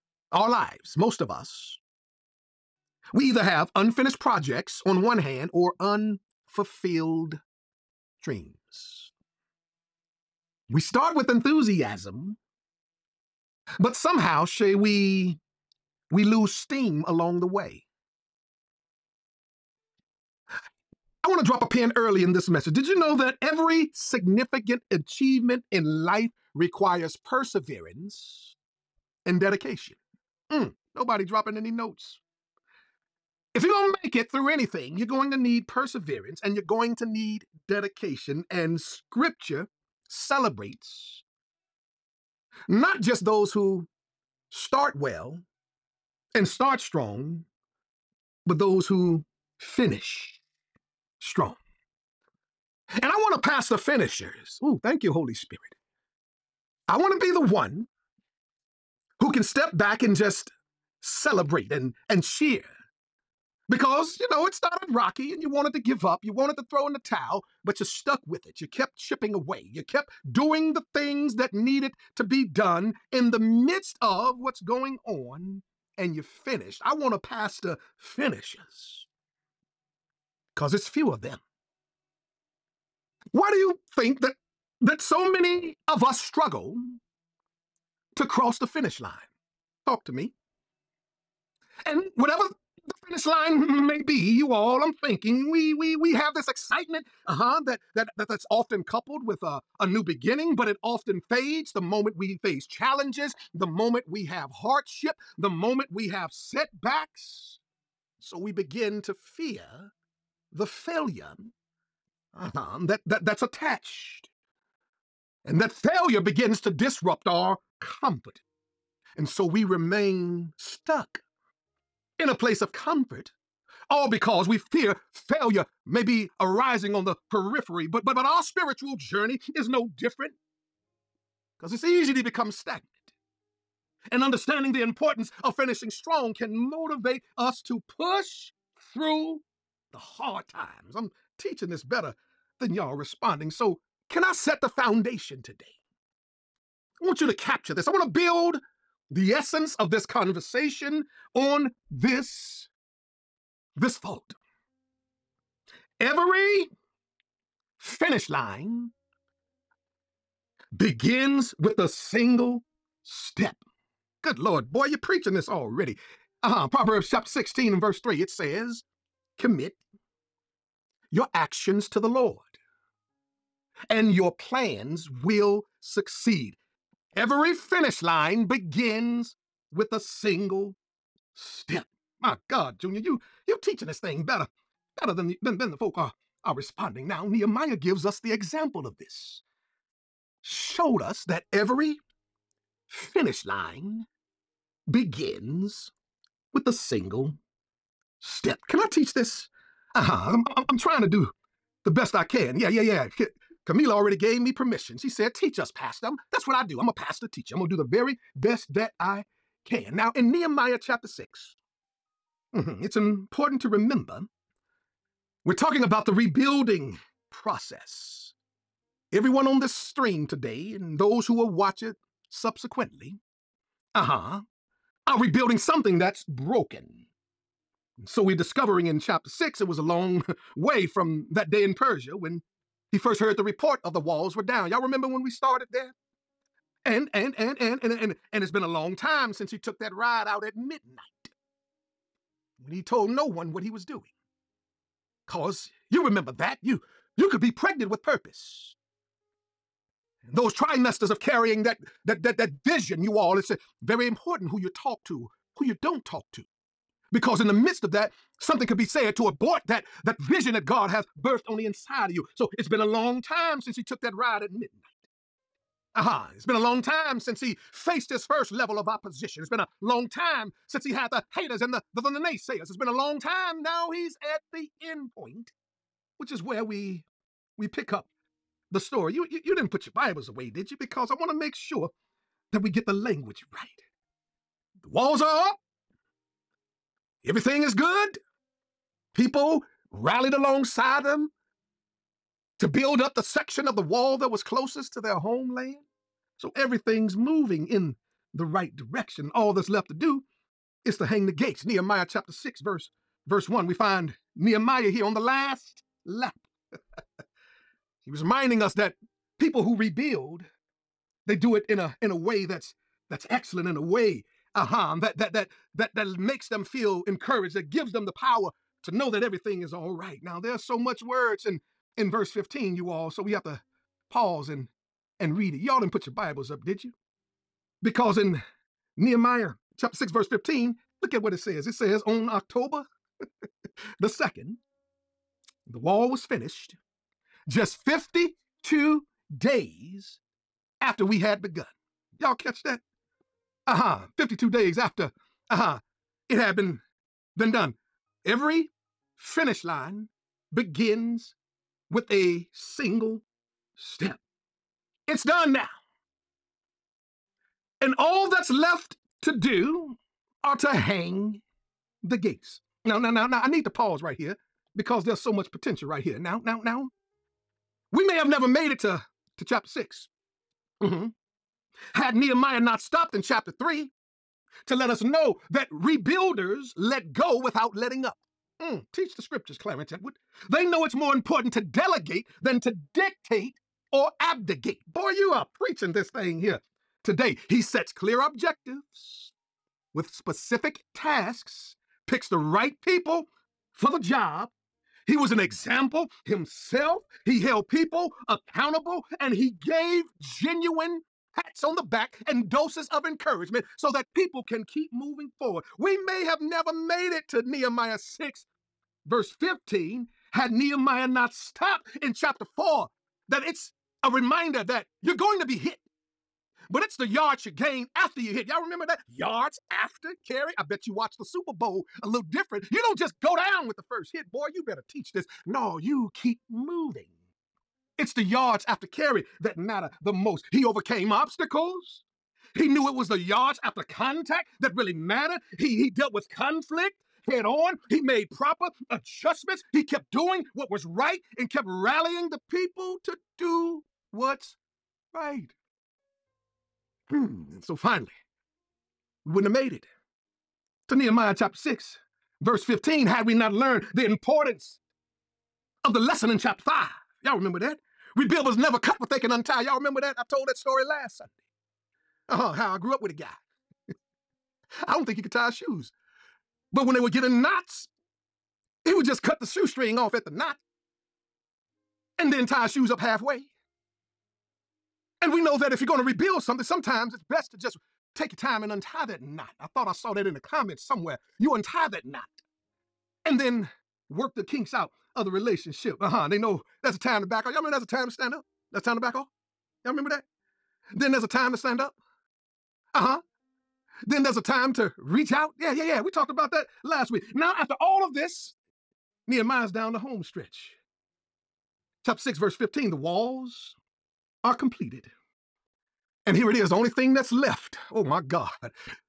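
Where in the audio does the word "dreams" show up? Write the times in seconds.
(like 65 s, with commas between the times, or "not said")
8 s.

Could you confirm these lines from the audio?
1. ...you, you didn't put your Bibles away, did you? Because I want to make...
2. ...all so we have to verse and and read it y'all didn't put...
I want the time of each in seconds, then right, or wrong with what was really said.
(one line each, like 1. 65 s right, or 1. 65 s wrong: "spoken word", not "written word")
1. 279 s right
2. 322 s wrong: "pause", not "verse".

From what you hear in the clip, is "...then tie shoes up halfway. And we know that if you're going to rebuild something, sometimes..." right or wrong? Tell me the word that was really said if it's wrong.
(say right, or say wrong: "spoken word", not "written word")
right.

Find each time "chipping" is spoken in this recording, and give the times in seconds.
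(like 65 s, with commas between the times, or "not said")
68 s.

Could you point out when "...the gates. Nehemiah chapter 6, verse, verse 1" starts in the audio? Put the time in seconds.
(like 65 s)
301 s.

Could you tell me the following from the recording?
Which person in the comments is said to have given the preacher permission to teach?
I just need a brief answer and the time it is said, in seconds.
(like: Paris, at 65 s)
Camila, at 203 s.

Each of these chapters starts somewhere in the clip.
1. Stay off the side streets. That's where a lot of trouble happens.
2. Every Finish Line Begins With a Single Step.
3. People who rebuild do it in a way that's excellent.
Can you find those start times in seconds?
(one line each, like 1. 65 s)
1. 496 s
2. 82 s
3. 279 s.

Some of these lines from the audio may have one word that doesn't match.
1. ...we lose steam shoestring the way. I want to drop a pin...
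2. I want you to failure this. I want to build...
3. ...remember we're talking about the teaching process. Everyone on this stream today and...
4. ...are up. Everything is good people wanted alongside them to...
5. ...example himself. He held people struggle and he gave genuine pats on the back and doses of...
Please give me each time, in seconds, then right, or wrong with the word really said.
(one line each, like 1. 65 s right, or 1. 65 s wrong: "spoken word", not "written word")
1. 16 s wrong: "along", not "shoestring"
2. 147 s wrong: "capture", not "failure"
3. 213 s wrong: "rebuilding", not "teaching"
4. 285 s wrong: "rallied", not "wanted"
5. 395 s wrong: "accountable", not "struggle".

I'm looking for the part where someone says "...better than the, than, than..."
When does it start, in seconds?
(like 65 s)
185 s.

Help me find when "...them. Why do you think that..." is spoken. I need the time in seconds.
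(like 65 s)
81 s.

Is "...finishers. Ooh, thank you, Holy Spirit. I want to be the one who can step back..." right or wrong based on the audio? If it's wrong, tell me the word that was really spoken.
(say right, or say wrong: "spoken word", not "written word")
right.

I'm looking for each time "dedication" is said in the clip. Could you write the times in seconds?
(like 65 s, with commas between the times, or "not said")
29 s, 37 s.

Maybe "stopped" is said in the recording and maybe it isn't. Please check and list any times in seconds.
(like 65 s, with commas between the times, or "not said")
372 s, 411 s.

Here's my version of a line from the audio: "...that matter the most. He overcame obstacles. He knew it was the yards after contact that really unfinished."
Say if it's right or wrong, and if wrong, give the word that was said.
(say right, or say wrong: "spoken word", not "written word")
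wrong: "mattered", not "unfinished".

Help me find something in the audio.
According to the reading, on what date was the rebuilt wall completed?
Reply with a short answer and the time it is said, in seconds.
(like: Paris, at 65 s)
October 2, at 332 s.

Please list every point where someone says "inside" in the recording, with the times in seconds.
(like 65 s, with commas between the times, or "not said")
261 s.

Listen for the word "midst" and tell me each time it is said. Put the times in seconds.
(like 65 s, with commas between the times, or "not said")
73 s, 257 s.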